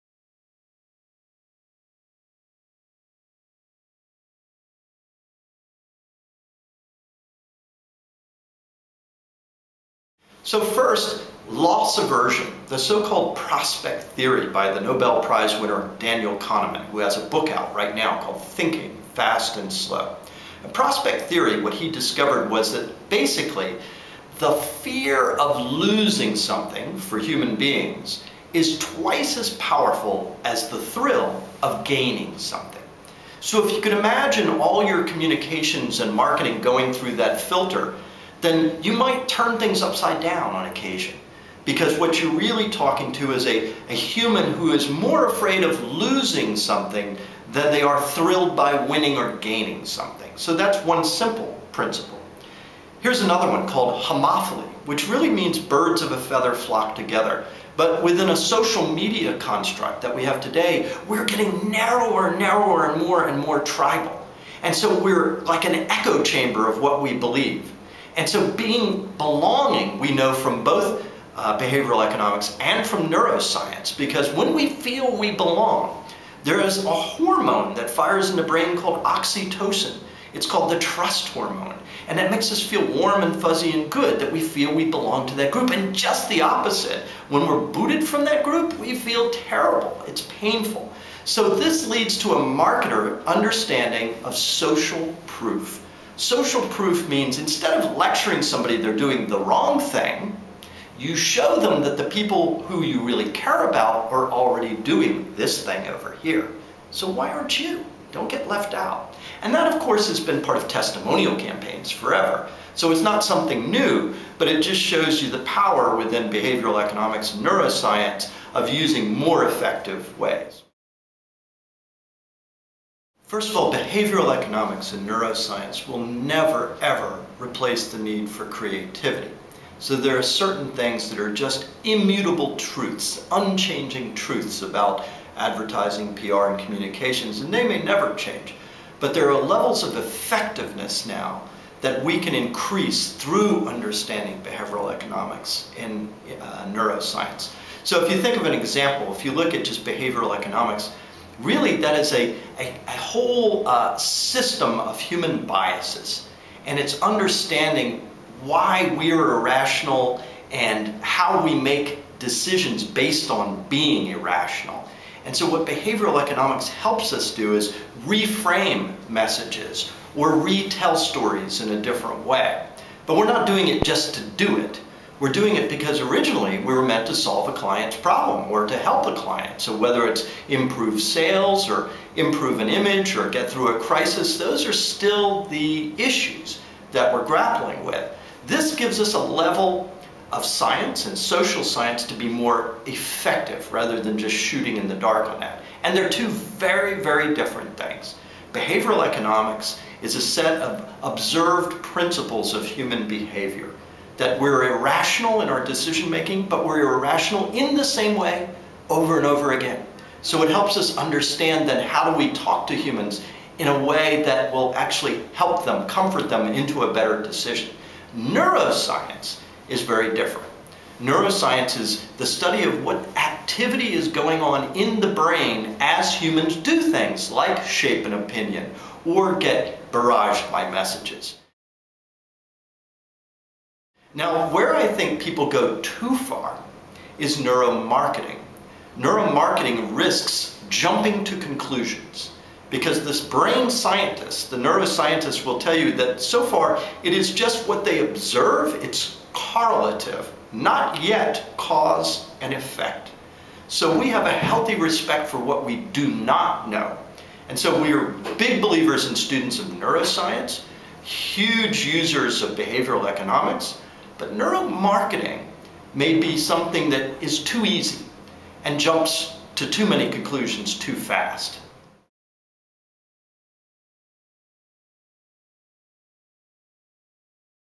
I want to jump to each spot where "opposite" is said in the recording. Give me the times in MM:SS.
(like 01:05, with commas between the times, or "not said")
01:26.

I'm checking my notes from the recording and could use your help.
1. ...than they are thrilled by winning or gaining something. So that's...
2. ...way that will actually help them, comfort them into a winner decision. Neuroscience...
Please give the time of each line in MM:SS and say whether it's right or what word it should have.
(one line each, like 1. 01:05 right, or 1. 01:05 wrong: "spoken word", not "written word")
1. 00:47 right
2. 03:33 wrong: "better", not "winner".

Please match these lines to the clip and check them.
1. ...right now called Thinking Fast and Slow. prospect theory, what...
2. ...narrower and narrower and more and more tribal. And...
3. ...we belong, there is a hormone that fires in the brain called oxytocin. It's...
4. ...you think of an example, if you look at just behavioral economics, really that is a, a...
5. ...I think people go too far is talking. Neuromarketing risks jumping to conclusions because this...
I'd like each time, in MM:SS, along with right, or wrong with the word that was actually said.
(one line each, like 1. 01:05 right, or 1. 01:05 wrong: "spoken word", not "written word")
1. 00:17 right
2. 01:01 right
3. 01:15 right
4. 02:28 right
5. 03:54 wrong: "neuromarketing", not "talking".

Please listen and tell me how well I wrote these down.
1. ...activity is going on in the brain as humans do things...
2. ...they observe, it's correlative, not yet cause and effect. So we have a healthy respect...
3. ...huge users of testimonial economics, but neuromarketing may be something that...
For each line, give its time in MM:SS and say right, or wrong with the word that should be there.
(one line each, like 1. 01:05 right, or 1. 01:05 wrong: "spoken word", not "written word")
1. 03:43 right
2. 04:07 right
3. 04:21 wrong: "behavioral", not "testimonial".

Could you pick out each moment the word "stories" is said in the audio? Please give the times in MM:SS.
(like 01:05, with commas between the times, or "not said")
02:50.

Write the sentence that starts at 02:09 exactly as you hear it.
So there are certain things that are just immutable truths, unchanging truths about advertising, PR, and communications, and they may never change.